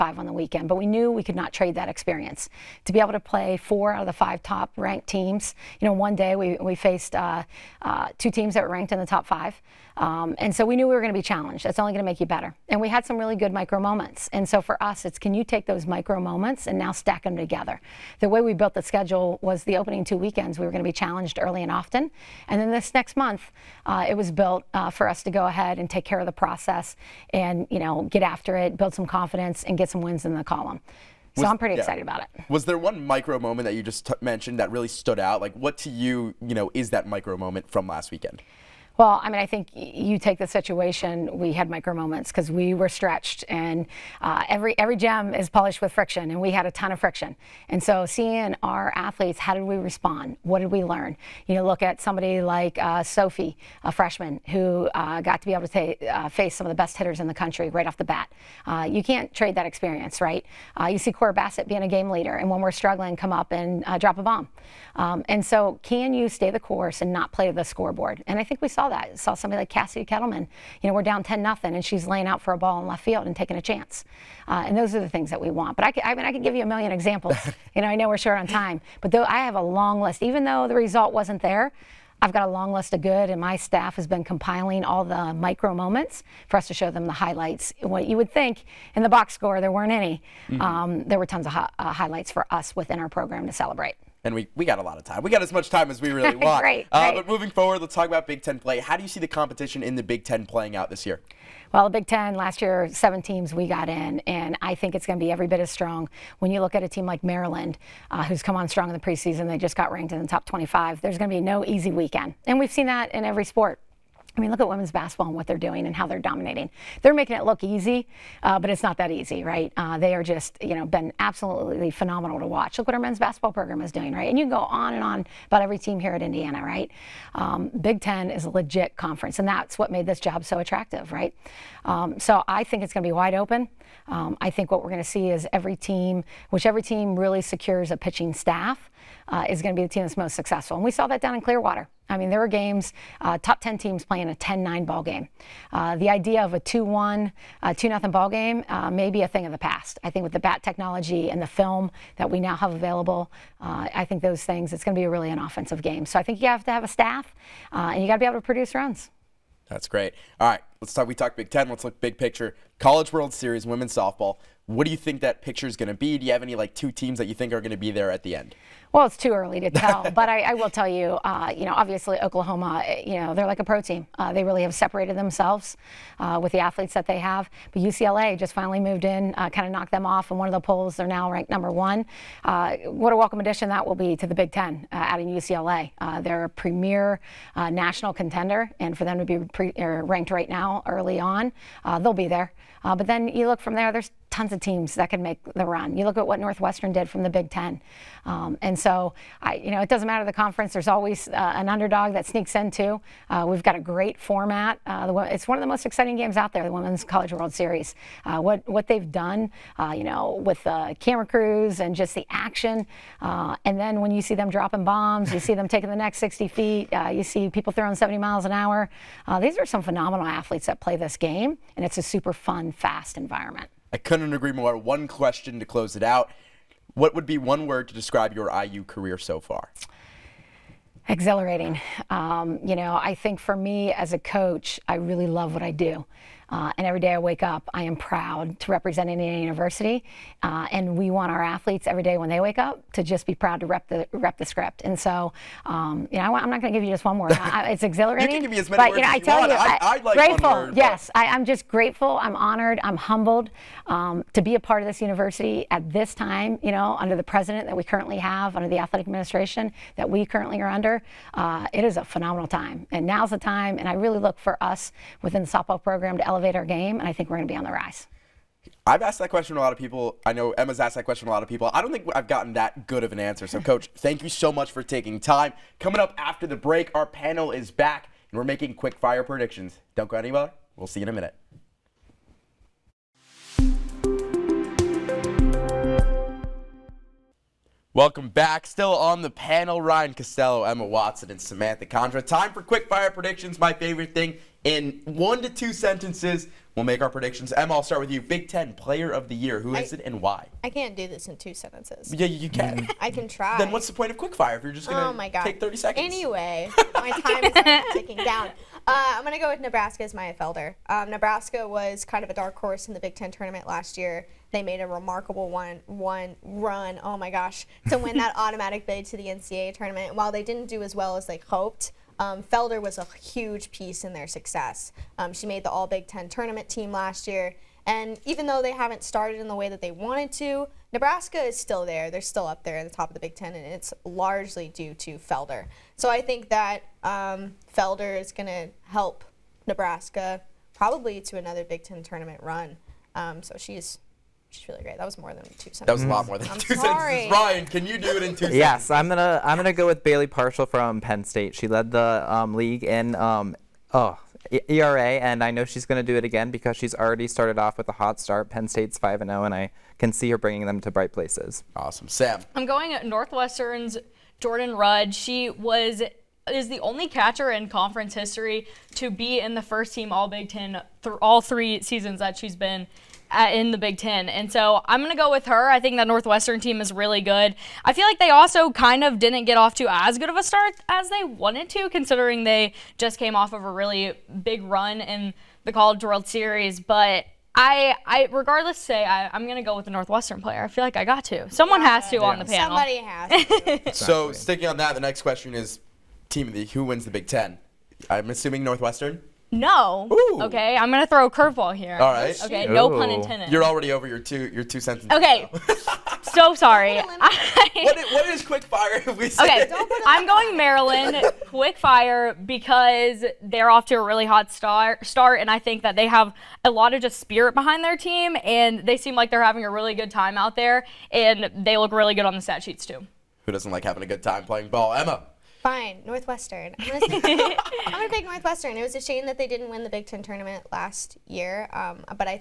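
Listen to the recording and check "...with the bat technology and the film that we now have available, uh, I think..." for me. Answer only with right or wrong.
right.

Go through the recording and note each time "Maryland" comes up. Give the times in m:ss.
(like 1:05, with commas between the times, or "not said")
1:47, 6:50.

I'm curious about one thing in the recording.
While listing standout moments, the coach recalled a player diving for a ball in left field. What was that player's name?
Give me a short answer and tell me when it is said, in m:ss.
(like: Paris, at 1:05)
Cassie Kettleman, at 1:09.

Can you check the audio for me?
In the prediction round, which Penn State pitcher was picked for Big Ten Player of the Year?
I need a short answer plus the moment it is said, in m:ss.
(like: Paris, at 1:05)
Bailey Parshall, at 5:50.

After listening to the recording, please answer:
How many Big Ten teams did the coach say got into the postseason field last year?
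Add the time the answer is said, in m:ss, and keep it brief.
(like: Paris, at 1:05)
7, at 1:42.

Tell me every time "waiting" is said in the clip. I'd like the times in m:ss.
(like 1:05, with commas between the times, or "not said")
not said.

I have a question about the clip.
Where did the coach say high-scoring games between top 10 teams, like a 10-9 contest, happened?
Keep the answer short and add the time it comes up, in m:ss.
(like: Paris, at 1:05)
Clearwater, at 2:21.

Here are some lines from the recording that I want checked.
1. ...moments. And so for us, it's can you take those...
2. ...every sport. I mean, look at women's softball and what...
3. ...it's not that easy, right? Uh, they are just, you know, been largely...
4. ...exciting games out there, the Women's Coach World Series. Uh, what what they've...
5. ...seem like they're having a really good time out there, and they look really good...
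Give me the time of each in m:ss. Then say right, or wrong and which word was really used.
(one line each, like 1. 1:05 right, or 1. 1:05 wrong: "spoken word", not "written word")
1. 0:13 right
2. 1:53 wrong: "basketball", not "softball"
3. 1:58 wrong: "absolutely", not "largely"
4. 3:25 wrong: "College", not "Coach"
5. 6:58 right.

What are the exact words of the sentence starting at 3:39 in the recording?
these are some phenomenal athletes that play this game, and it's a super fun, fast environment.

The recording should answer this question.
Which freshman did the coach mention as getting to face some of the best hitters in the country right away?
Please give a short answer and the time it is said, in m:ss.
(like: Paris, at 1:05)
Sophie, at 0:53.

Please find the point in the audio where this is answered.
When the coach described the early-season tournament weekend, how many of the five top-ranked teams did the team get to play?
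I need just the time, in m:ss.
0:03.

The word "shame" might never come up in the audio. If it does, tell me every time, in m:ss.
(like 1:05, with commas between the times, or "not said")
7:09.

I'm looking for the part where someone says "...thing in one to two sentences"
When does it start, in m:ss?
4:54.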